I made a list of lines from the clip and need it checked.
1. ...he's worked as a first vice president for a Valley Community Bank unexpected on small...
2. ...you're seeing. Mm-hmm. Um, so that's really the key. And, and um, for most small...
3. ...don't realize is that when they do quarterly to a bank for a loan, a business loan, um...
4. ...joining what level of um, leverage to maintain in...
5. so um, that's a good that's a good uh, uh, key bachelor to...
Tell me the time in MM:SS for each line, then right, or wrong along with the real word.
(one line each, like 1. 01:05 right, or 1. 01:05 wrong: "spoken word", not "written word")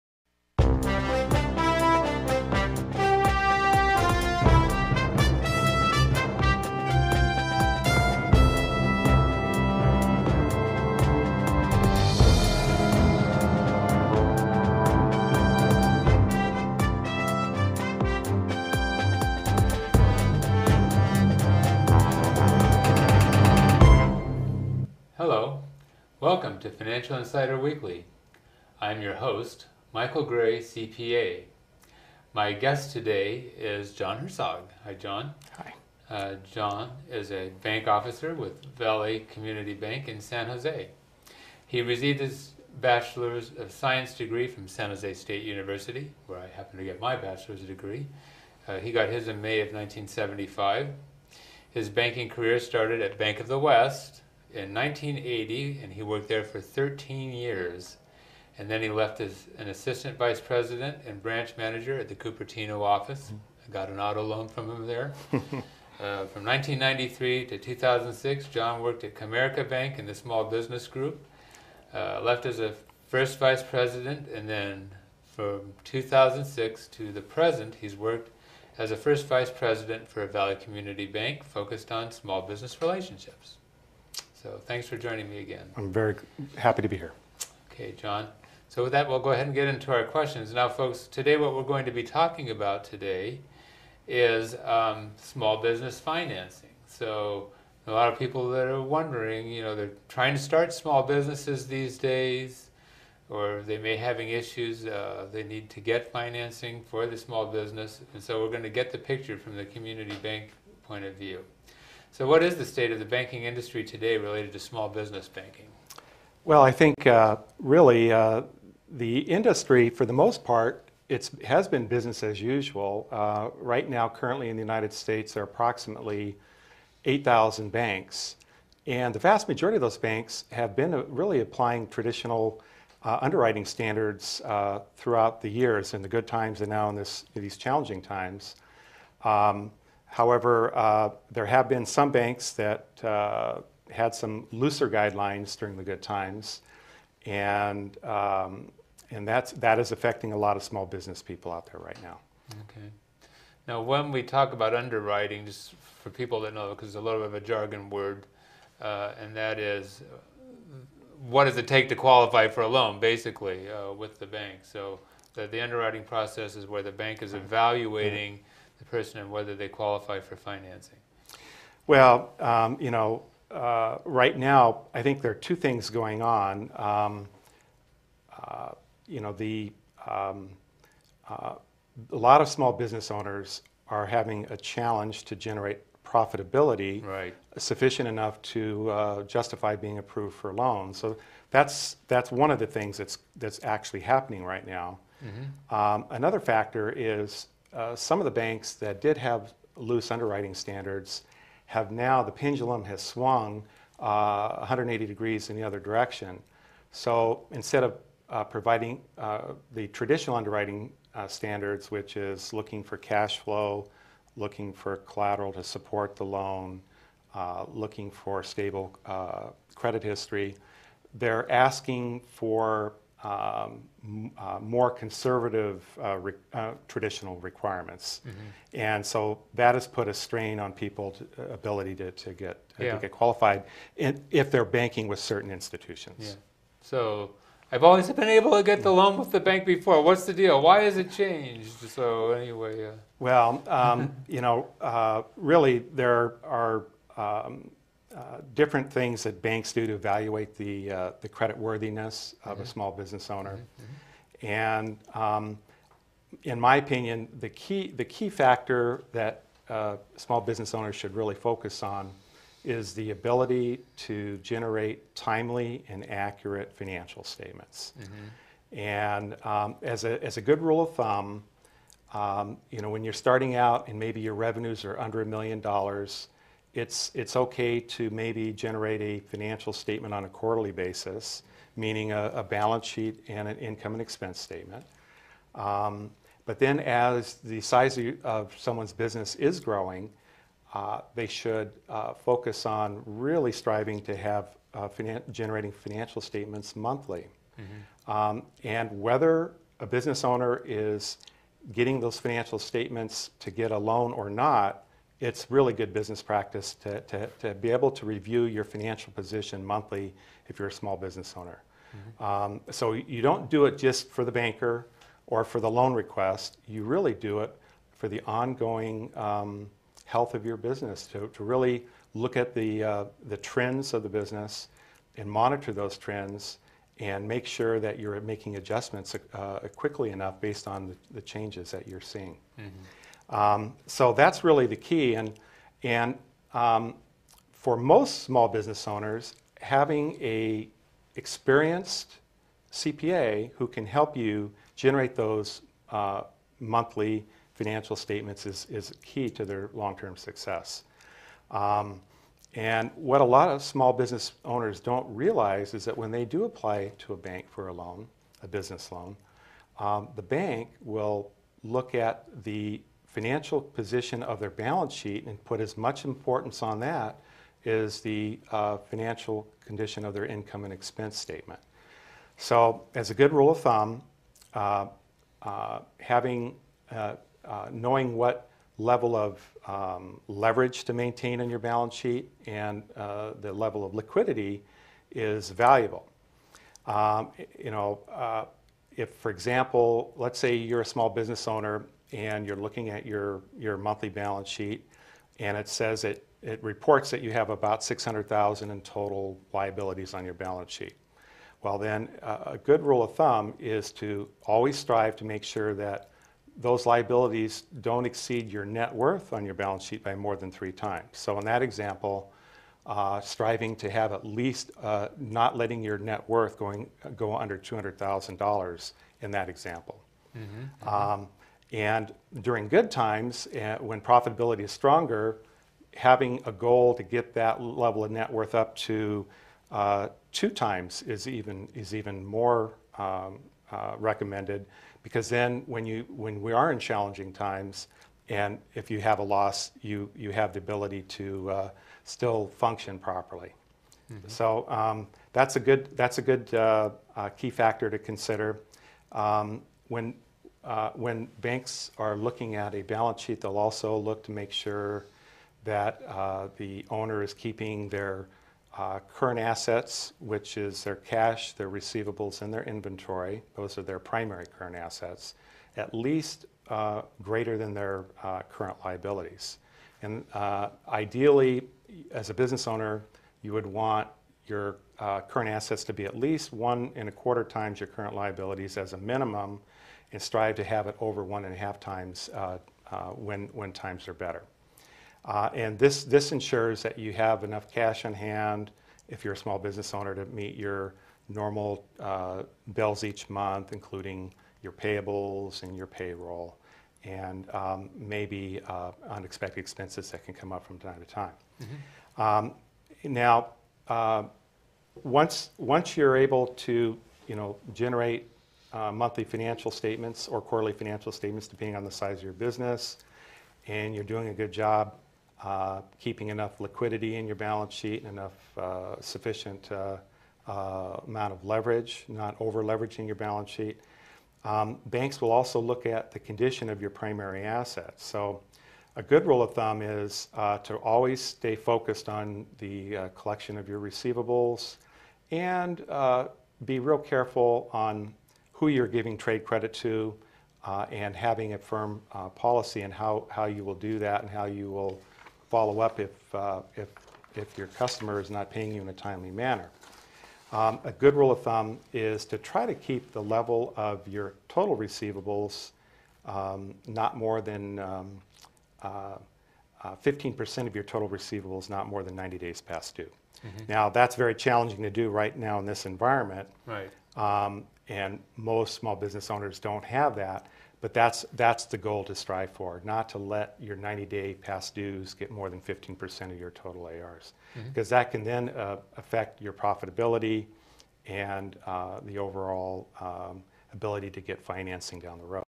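1. 01:17 wrong: "focused", not "unexpected"
2. 05:31 right
3. 05:54 wrong: "apply", not "quarterly"
4. 06:17 wrong: "knowing", not "joining"
5. 07:24 wrong: "factor", not "bachelor".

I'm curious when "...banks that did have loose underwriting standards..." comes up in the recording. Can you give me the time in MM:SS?
03:18.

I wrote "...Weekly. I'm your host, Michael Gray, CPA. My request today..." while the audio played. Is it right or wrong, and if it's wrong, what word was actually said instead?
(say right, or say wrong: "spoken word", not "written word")
wrong: "guest", not "request".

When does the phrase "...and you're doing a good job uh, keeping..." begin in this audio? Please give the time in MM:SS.
08:33.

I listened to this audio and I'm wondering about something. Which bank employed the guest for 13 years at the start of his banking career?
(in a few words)
Bank of the West.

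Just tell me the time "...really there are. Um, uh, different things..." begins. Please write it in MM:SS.
04:05.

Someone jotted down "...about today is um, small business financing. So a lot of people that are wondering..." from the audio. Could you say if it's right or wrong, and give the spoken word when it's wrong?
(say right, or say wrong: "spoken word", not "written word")
right.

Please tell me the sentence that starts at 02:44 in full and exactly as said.
So, the, the underwriting process is where the bank is evaluating.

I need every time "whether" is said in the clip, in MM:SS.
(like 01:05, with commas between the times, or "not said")
02:49, 04:59.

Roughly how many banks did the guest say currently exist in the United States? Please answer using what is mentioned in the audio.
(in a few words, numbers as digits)
8,000.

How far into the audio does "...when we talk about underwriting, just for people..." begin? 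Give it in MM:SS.
02:33.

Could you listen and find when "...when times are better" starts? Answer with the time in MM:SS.
08:03.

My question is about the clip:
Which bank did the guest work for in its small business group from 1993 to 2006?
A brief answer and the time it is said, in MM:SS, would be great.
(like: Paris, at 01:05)
Comerica Bank, at 01:09.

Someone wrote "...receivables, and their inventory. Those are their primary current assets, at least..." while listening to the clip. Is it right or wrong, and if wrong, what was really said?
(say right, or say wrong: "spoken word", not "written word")
right.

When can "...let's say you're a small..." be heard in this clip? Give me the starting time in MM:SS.
06:30.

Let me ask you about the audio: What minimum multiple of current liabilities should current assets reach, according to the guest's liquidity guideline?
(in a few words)
1.25 times.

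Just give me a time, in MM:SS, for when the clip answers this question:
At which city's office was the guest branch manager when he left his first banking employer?
01:02.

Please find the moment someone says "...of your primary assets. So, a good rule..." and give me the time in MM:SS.
08:46.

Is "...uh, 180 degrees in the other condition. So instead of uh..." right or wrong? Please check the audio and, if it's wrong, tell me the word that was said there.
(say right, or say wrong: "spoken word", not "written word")
wrong: "direction", not "condition".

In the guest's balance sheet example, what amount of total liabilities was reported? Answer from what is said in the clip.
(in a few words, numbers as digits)
600,000.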